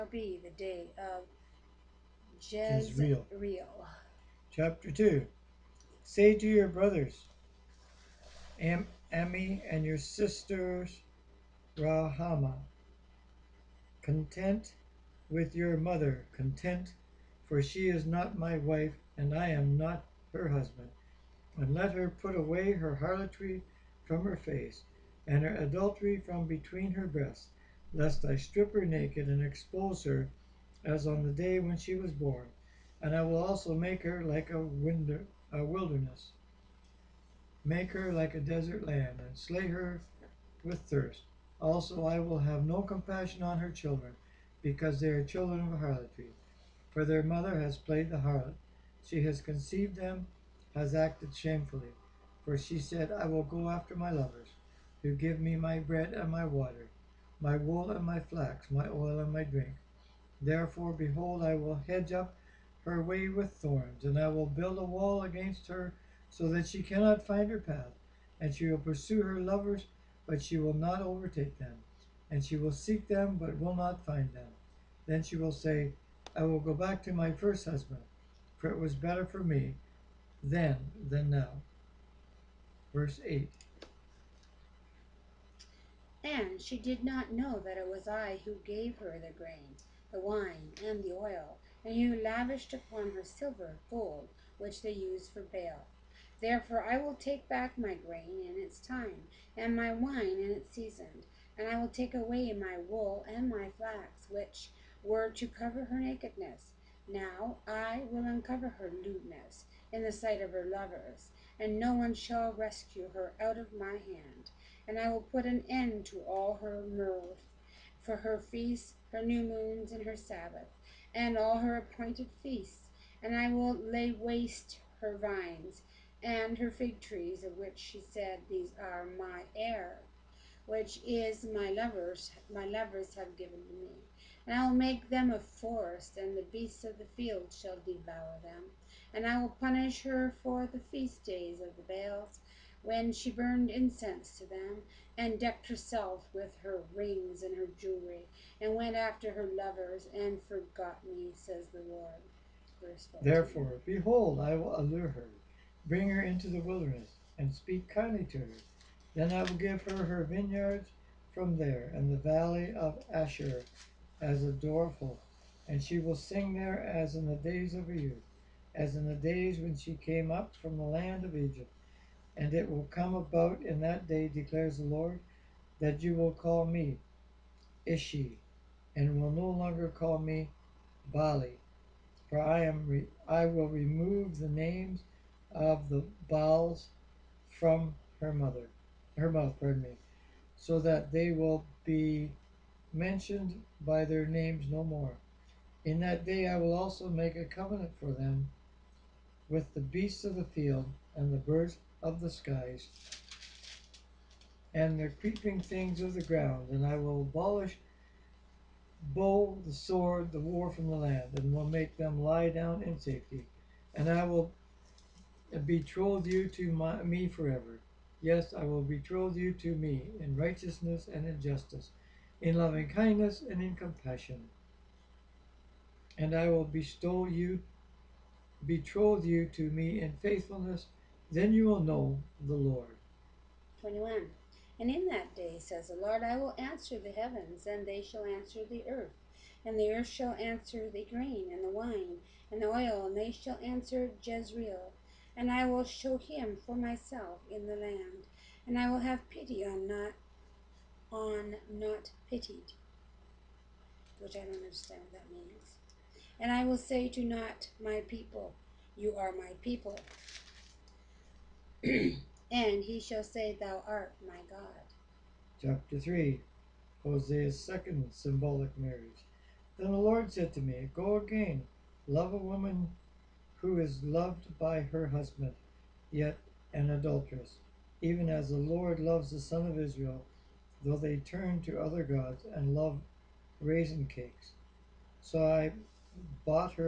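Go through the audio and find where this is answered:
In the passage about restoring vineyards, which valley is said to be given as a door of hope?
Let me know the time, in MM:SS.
02:42.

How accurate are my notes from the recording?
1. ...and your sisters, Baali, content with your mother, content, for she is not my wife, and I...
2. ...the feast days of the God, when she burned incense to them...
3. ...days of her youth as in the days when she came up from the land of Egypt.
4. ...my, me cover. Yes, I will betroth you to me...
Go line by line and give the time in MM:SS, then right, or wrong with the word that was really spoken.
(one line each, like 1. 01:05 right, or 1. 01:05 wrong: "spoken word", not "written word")
1. 00:09 wrong: "Rahama", not "Baali"
2. 02:20 wrong: "Baals", not "God"
3. 02:47 right
4. 03:36 wrong: "forever", not "cover".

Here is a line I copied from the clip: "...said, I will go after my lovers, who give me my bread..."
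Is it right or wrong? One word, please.
right.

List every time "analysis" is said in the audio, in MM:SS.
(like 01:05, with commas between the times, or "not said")
not said.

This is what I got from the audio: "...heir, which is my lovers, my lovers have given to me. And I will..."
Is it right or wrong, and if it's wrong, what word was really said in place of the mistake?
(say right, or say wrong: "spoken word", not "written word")
right.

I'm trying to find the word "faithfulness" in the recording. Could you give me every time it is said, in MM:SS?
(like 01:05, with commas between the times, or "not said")
03:50.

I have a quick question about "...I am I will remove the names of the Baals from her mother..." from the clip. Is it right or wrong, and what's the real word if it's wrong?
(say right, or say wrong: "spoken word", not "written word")
right.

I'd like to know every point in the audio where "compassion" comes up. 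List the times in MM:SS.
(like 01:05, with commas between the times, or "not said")
00:42, 03:43.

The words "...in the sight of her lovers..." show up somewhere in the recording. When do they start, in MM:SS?
01:49.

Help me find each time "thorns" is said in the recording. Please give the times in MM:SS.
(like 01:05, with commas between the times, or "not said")
01:03.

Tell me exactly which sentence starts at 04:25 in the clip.
Chapter 3 Hosea's second symbolic marriage.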